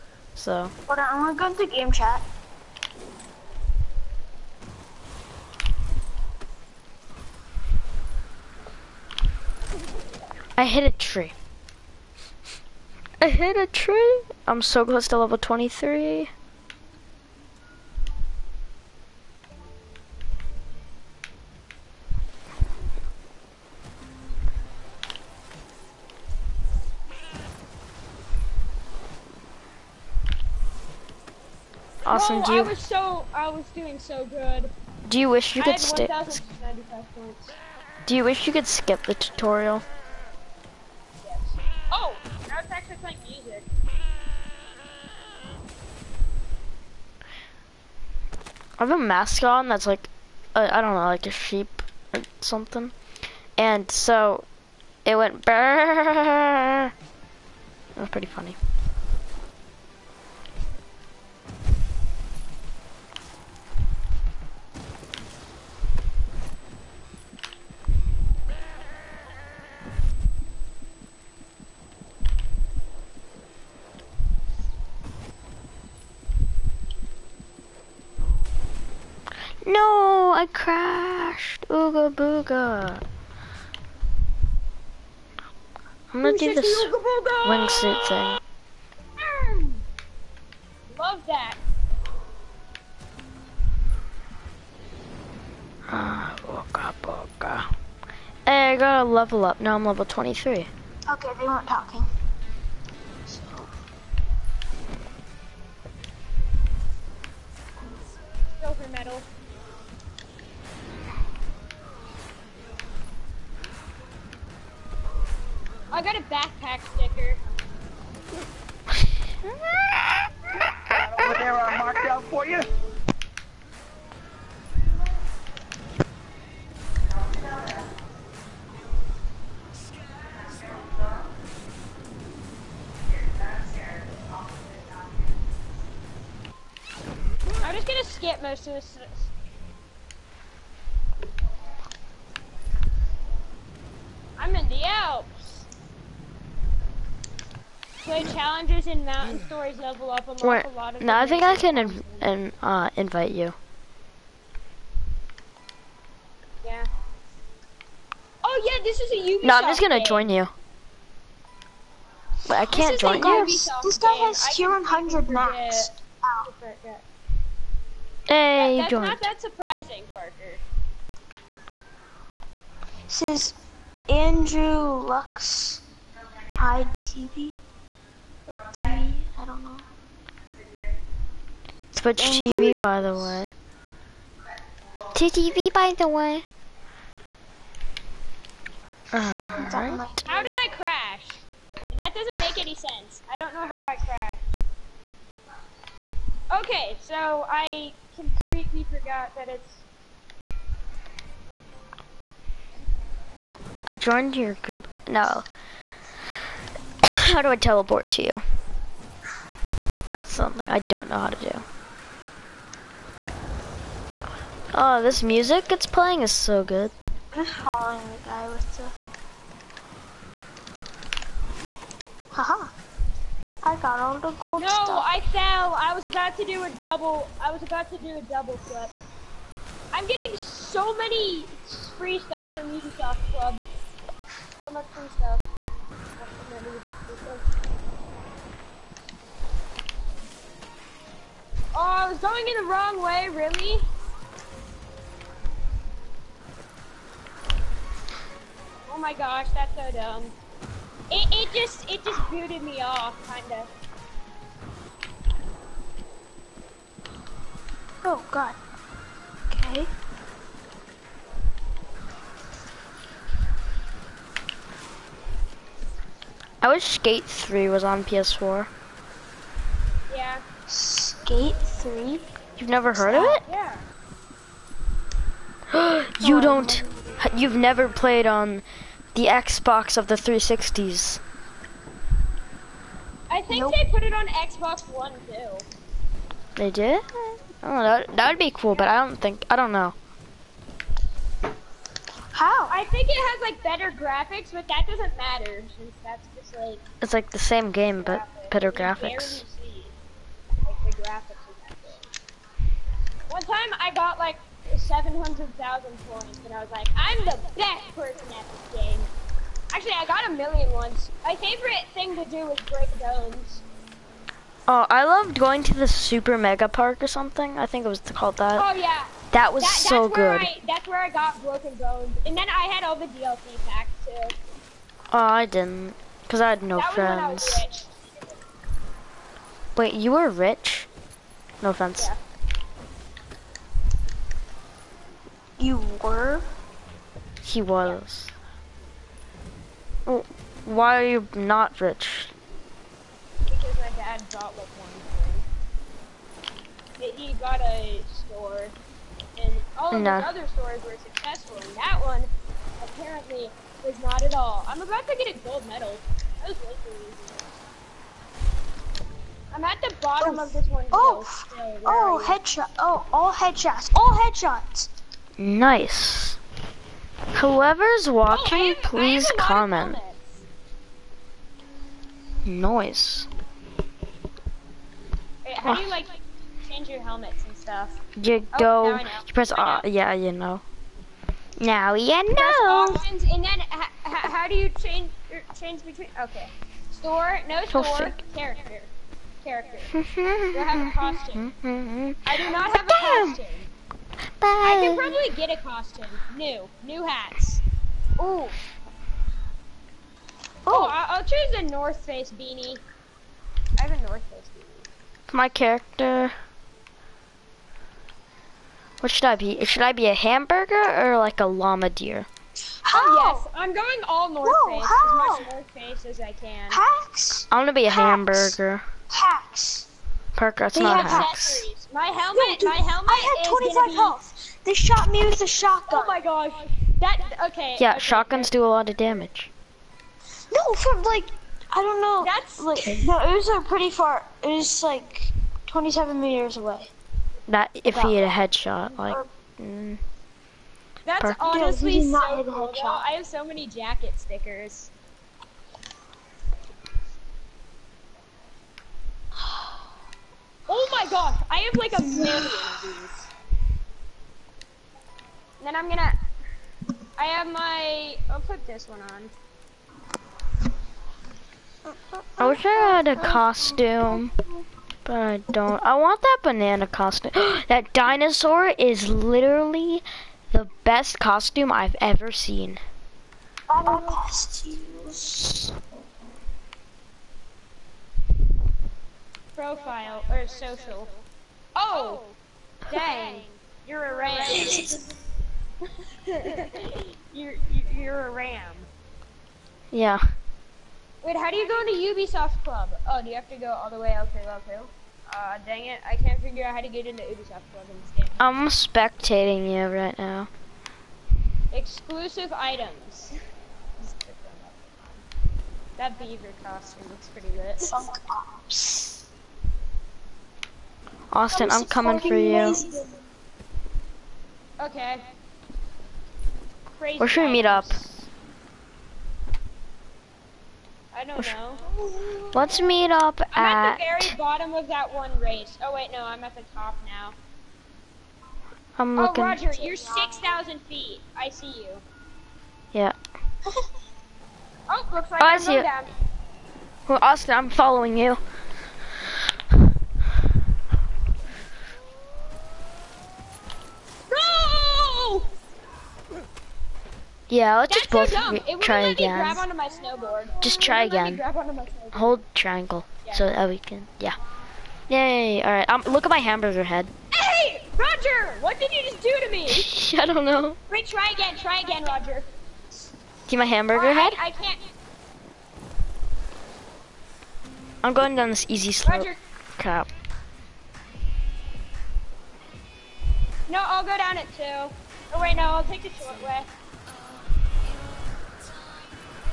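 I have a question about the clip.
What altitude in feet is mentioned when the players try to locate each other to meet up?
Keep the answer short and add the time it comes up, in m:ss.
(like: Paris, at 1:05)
6,000, at 8:49.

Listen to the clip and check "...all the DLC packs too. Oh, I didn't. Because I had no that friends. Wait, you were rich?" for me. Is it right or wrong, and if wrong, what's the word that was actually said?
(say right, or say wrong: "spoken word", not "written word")
right.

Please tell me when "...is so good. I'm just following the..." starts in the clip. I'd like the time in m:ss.
3:36.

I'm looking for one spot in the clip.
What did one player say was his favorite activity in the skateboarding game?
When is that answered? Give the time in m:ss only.
5:12.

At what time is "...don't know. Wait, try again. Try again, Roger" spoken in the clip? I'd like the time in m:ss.
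9:20.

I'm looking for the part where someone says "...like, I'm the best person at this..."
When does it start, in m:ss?
5:06.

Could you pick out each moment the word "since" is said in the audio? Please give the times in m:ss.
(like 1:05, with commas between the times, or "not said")
4:55.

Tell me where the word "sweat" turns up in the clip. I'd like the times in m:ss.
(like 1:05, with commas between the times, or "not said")
not said.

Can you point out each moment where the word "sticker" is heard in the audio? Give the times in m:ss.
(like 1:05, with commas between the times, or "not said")
1:56, 7:24.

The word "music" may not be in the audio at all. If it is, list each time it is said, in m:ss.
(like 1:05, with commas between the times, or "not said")
3:35.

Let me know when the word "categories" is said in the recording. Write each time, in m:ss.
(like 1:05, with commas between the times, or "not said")
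not said.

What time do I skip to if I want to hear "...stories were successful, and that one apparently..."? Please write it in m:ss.
5:50.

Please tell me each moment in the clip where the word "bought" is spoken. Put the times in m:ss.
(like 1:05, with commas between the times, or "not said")
5:44.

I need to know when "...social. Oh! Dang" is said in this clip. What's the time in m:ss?
8:00.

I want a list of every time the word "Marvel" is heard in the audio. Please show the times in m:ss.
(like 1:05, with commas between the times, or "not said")
not said.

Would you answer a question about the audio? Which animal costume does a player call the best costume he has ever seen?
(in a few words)
dinosaur.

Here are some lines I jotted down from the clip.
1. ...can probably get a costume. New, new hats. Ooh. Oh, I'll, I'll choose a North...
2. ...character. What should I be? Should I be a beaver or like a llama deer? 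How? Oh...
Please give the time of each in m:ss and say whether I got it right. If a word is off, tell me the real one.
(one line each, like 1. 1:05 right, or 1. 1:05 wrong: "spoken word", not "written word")
1. 6:34 right
2. 6:45 wrong: "hamburger", not "beaver".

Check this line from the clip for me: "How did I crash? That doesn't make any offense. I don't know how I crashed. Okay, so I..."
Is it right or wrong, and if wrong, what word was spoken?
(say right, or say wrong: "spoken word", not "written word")
wrong: "sense", not "offense".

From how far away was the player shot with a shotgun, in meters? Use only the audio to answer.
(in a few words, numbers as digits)
27.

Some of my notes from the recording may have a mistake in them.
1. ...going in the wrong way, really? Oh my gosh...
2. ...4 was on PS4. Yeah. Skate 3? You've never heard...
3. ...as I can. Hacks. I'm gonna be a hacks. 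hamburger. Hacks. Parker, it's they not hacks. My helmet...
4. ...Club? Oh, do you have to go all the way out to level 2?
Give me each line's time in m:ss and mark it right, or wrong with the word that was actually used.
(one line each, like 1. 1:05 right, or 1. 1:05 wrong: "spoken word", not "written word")
1. 4:02 right
2. 4:27 wrong: "3", not "4"
3. 6:56 right
4. 8:12 right.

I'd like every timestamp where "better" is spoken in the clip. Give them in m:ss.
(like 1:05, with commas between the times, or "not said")
4:53, 4:58.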